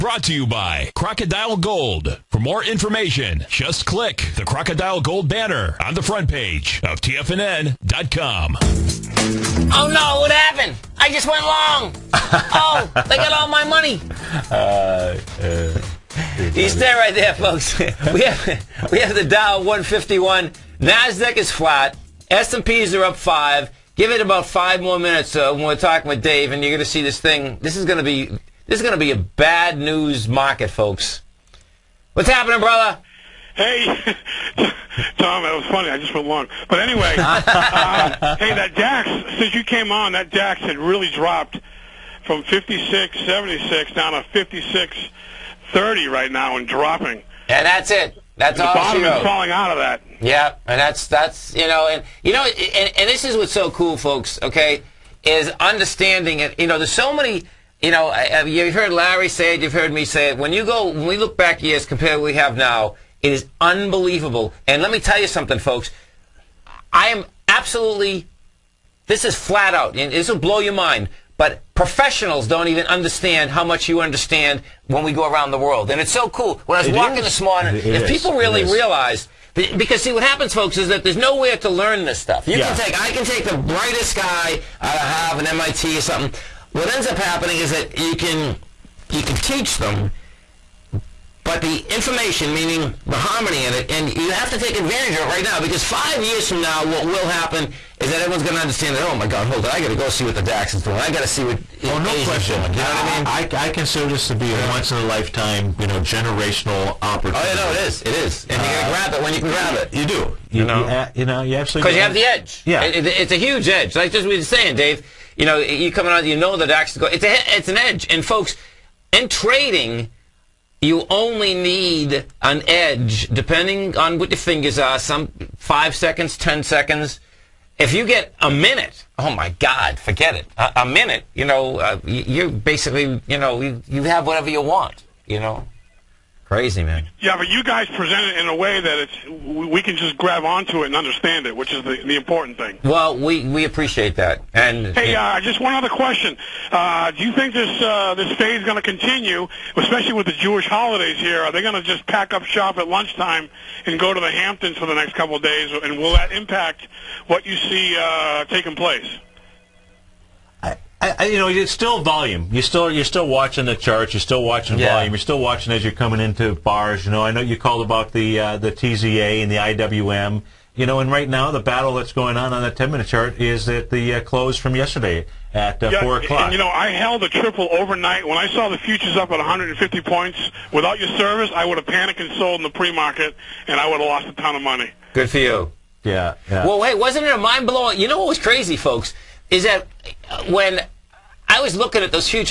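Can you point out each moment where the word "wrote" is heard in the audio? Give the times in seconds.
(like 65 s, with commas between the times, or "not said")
49 s.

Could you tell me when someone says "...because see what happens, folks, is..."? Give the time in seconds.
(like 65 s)
79 s.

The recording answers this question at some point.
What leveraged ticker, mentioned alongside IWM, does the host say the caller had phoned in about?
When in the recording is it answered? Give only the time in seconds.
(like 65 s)
168 s.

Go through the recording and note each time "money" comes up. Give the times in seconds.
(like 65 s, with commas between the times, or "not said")
13 s, 184 s.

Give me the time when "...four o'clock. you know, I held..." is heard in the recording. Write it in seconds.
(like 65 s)
176 s.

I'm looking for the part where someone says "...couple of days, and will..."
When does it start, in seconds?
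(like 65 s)
155 s.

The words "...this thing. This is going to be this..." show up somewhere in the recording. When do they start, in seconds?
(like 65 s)
27 s.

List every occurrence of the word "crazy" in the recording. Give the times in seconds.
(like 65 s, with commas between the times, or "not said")
136 s, 188 s.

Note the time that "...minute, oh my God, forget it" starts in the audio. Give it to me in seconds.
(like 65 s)
128 s.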